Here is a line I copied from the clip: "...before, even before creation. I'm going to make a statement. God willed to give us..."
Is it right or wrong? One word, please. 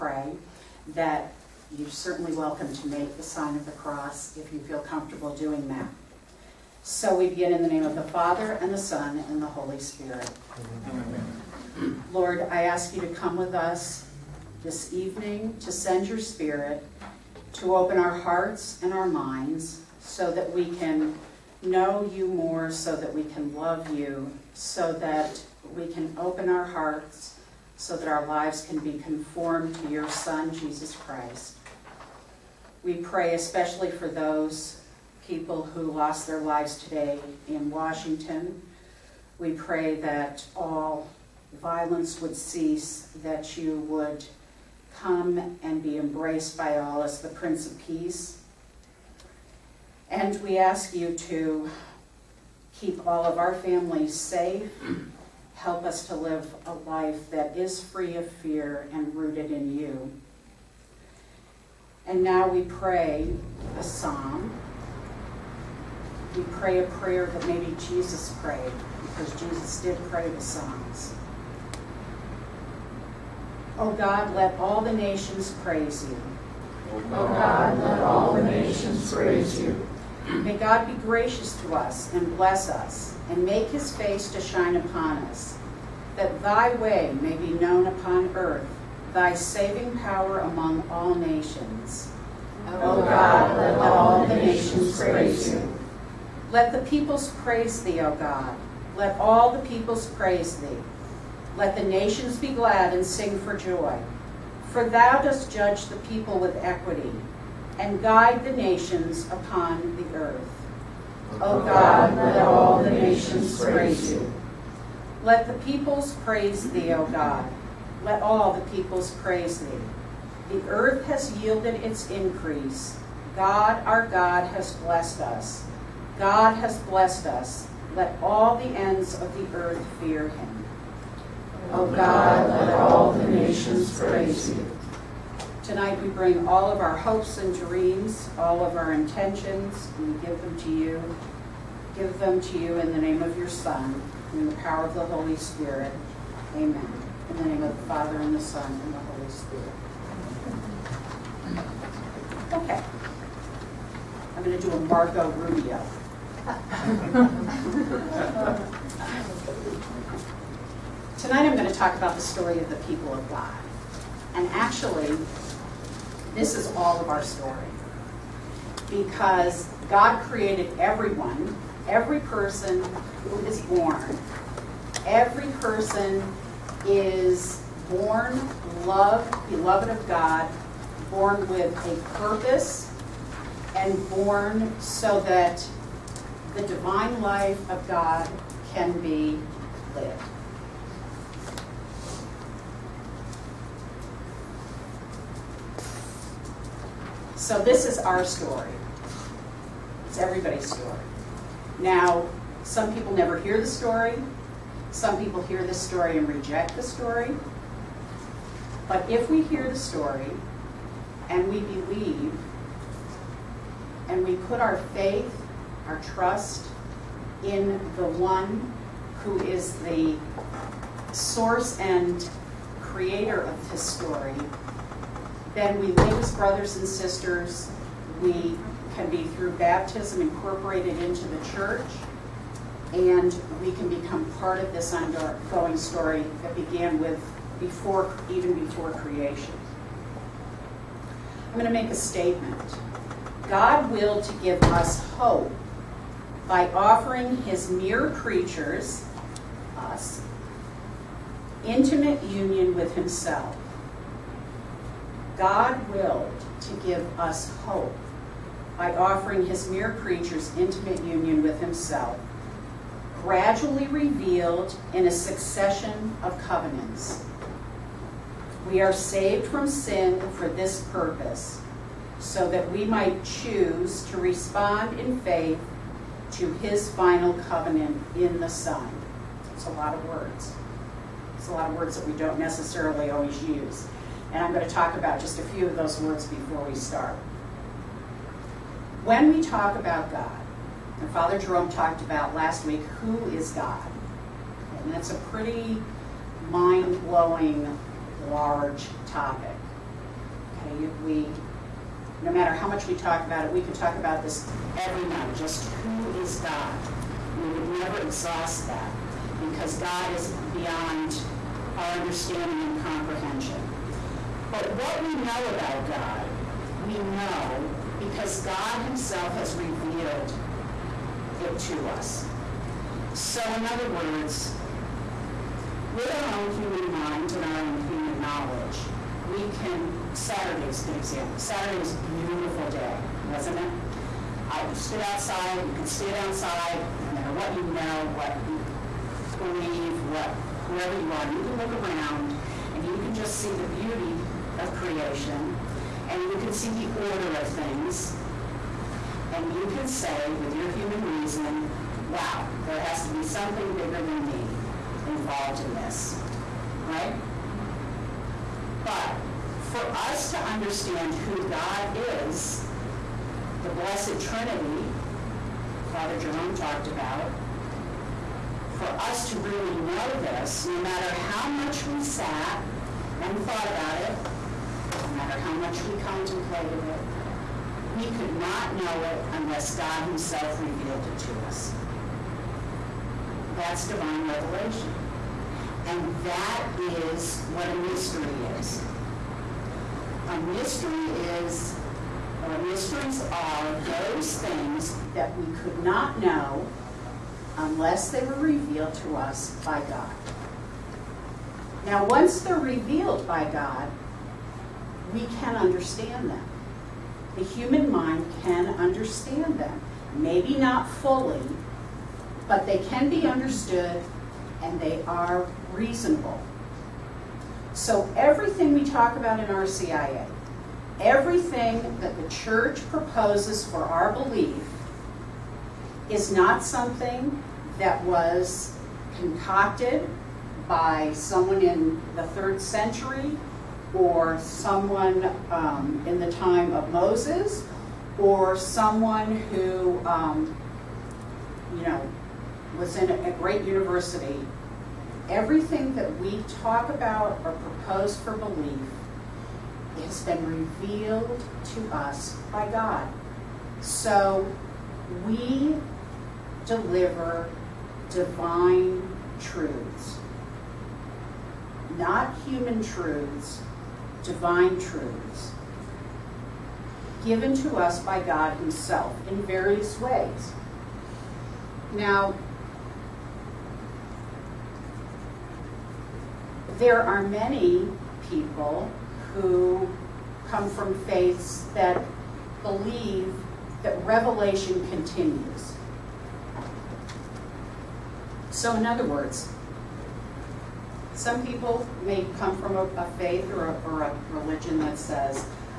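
right.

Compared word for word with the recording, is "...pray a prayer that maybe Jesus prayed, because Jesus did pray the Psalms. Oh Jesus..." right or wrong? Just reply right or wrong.
wrong.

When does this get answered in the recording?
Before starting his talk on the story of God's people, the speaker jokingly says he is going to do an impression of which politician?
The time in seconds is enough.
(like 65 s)
154 s.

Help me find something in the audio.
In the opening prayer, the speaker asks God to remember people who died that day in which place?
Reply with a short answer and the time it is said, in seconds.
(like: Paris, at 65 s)
Washington, at 37 s.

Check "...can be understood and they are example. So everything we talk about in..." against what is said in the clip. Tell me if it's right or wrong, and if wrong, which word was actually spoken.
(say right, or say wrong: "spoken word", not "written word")
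wrong: "reasonable", not "example".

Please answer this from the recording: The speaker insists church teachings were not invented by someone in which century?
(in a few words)
Third century.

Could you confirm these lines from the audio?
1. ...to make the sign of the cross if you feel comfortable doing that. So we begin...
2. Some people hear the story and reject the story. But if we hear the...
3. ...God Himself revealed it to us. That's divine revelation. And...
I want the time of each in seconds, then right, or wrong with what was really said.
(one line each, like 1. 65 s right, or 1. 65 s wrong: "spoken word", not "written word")
1. 2 s right
2. 204 s right
3. 379 s right.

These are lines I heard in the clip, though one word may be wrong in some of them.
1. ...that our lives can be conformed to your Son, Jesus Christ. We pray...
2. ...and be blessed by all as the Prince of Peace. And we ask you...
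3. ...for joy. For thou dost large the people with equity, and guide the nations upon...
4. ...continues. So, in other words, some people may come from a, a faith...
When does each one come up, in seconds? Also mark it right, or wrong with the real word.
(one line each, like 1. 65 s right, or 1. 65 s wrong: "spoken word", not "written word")
1. 27 s right
2. 45 s wrong: "embraced", not "blessed"
3. 103 s wrong: "judge", not "large"
4. 484 s right.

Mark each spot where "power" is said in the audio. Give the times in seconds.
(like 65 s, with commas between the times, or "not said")
89 s, 144 s.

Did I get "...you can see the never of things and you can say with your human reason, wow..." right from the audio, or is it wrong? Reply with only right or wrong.
wrong.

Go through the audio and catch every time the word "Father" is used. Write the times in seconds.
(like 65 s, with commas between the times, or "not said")
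8 s, 147 s, 291 s, 365 s.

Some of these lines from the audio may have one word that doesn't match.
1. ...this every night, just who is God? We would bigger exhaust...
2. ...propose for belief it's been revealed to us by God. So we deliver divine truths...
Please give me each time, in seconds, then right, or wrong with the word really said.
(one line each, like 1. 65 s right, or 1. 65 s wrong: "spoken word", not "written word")
1. 304 s wrong: "never", not "bigger"
2. 447 s right.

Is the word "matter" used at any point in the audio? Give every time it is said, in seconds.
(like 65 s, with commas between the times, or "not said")
302 s, 337 s, 370 s, 375 s.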